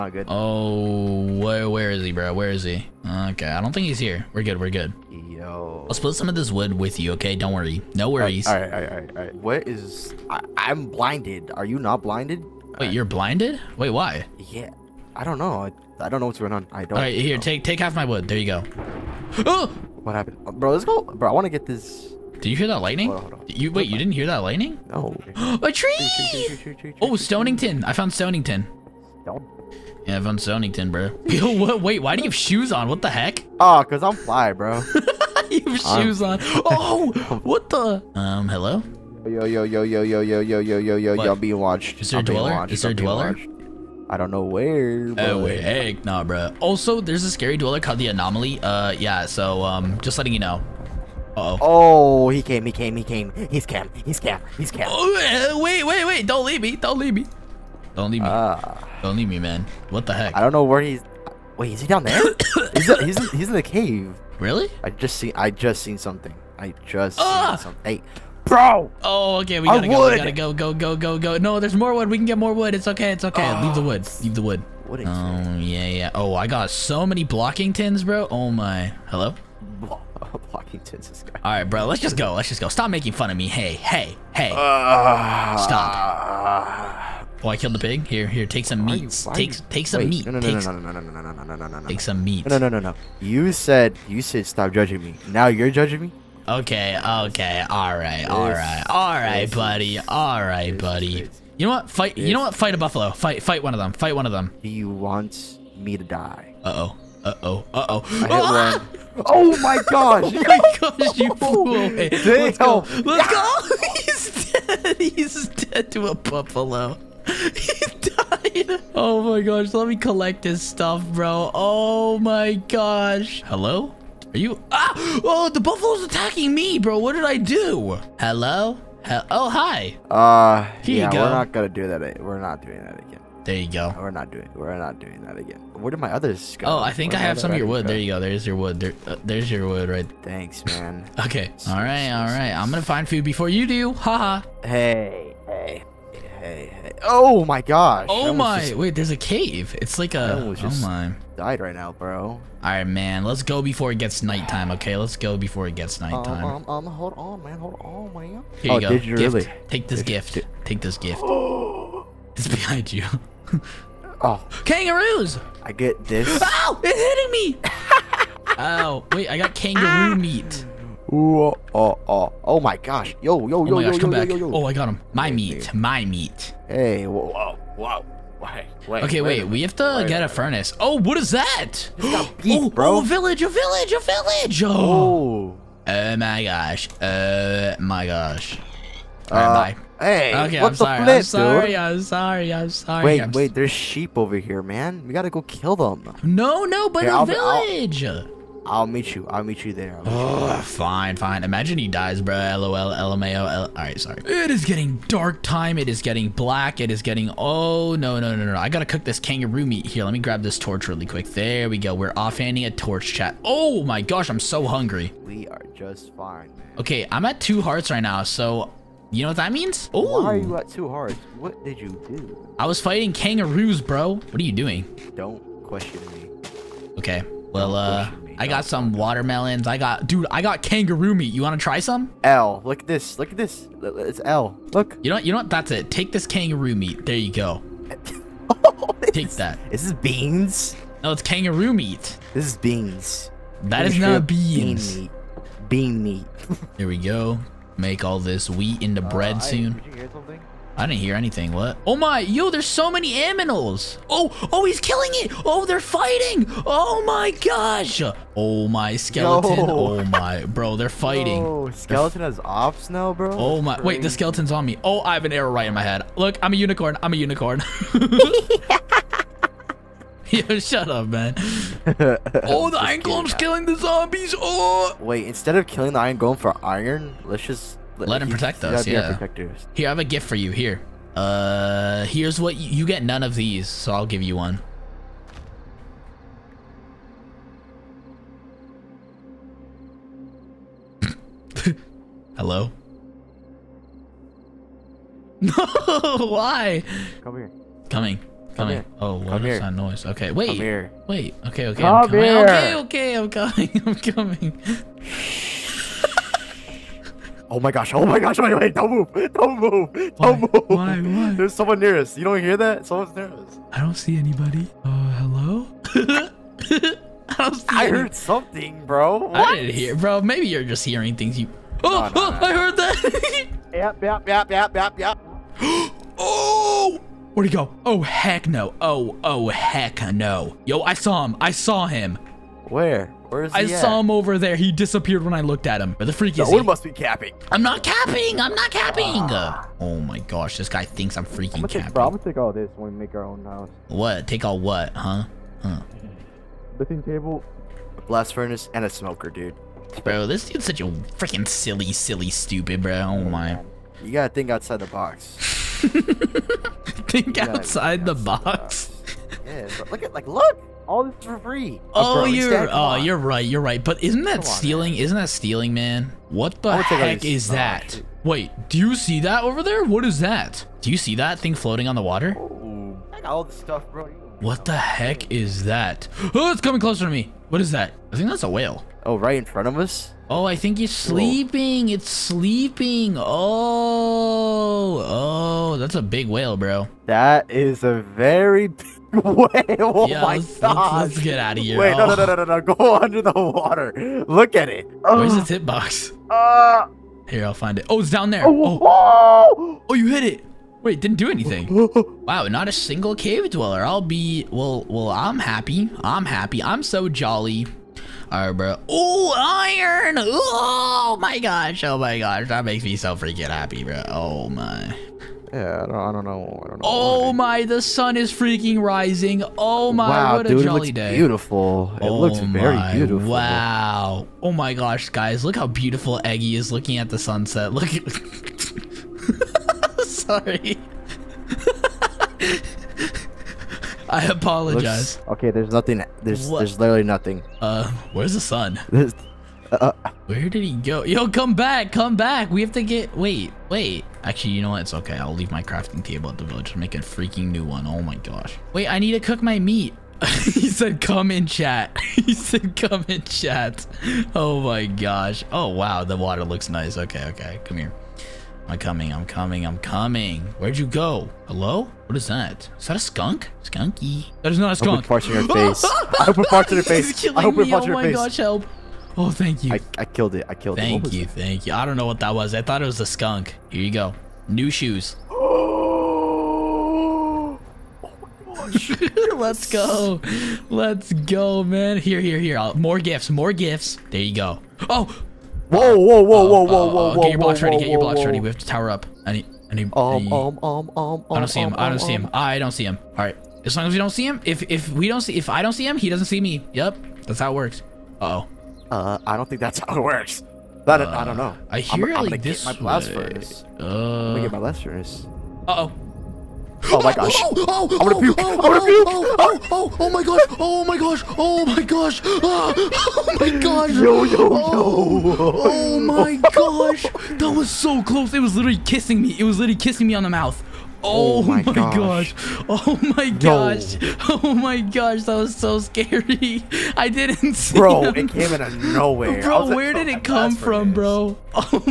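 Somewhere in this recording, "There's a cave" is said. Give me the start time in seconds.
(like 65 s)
148 s.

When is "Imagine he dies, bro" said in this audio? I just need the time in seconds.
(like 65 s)
201 s.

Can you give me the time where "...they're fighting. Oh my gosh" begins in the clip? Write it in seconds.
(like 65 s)
255 s.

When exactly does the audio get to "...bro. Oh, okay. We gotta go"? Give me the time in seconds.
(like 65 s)
68 s.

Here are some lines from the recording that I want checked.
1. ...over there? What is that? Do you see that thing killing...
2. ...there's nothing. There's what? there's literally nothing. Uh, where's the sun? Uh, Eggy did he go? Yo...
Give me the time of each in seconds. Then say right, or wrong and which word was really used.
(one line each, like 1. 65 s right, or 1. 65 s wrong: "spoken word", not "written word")
1. 369 s wrong: "floating", not "killing"
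2. 435 s wrong: "Where", not "Eggy".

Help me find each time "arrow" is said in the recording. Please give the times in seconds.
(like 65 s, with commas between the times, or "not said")
265 s.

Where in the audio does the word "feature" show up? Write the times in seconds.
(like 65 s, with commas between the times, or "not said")
not said.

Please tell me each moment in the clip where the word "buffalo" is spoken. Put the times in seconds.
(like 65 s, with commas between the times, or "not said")
102 s, 116 s, 125 s.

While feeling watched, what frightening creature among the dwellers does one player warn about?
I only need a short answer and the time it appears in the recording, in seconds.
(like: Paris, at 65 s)
the Anomaly, at 47 s.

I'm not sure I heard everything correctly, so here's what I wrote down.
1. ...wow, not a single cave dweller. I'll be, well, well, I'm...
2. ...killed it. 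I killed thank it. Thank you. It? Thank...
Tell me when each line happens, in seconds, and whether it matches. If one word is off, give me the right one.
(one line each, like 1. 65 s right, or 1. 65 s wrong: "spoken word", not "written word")
1. 402 s right
2. 470 s right.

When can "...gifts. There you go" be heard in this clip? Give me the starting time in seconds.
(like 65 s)
483 s.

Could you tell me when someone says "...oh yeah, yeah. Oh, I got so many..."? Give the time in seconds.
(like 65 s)
75 s.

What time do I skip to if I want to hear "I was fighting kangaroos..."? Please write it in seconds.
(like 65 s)
222 s.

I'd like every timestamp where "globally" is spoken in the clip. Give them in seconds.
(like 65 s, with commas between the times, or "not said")
not said.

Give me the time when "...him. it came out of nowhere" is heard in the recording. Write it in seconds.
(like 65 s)
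528 s.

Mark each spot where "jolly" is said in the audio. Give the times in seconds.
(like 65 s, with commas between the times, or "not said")
407 s, 420 s.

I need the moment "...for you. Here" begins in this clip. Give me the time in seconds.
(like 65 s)
280 s.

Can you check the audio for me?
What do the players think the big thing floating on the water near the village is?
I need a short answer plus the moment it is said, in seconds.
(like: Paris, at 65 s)
a whale, at 378 s.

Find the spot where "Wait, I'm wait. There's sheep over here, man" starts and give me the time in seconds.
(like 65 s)
193 s.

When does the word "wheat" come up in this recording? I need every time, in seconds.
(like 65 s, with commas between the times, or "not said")
248 s.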